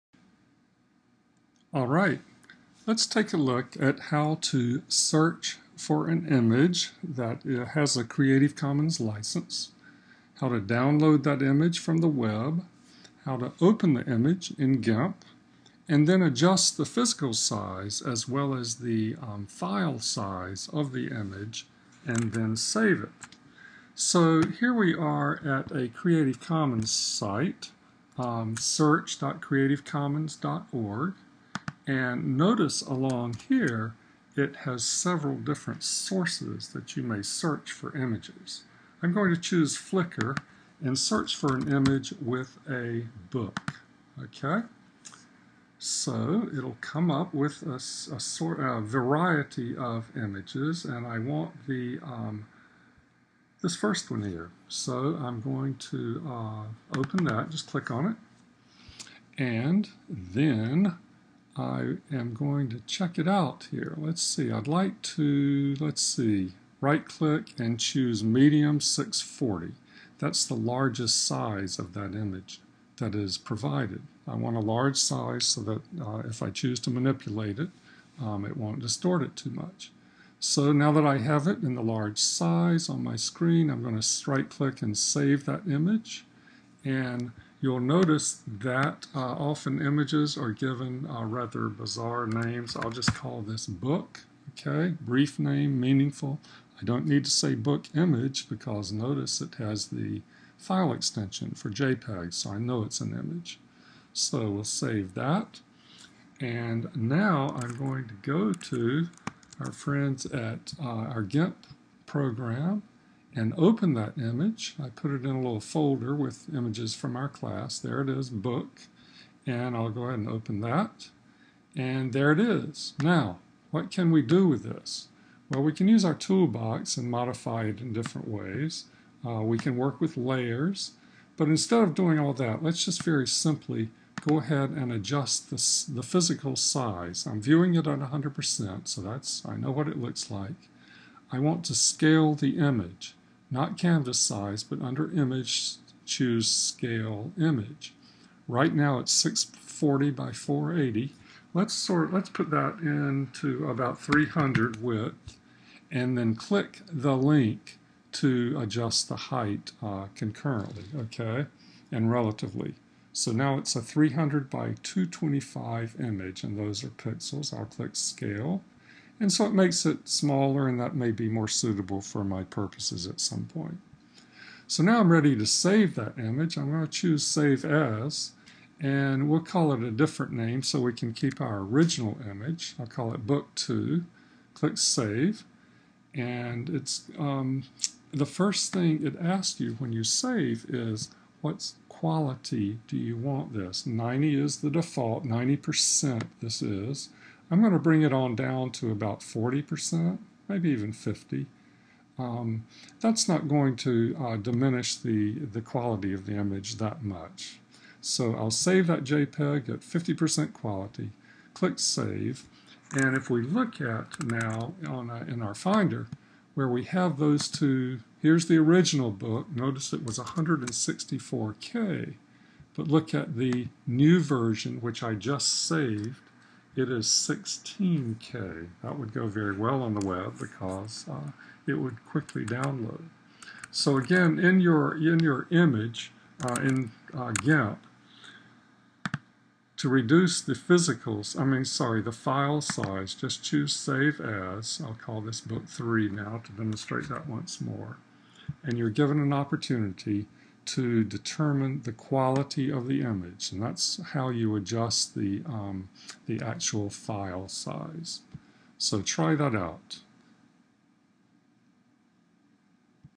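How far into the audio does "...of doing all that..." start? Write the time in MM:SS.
02:11.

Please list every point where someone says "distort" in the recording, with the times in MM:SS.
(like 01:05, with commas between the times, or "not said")
01:18.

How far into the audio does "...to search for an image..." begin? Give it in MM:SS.
00:04.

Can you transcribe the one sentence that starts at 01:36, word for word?
I don't need to say book image because notice it has the file extension for JPEG, so I know it's an image.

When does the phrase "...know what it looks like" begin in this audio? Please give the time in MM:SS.
02:19.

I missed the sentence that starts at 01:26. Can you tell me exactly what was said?
And You'll notice that uh, often images are given uh, rather bizarre names.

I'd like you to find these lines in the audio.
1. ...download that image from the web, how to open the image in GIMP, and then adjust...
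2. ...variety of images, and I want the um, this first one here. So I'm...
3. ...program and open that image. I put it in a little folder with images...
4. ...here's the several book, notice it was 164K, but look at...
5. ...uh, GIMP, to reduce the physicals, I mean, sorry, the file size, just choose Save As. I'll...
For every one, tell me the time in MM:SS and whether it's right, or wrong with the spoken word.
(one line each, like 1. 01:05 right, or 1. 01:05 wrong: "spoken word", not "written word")
1. 00:10 right
2. 00:48 right
3. 01:52 right
4. 03:38 wrong: "original", not "several"
5. 03:57 right.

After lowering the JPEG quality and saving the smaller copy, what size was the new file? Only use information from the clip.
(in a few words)
16K.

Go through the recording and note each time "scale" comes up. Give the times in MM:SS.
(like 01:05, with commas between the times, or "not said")
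02:21, 02:26, 02:47.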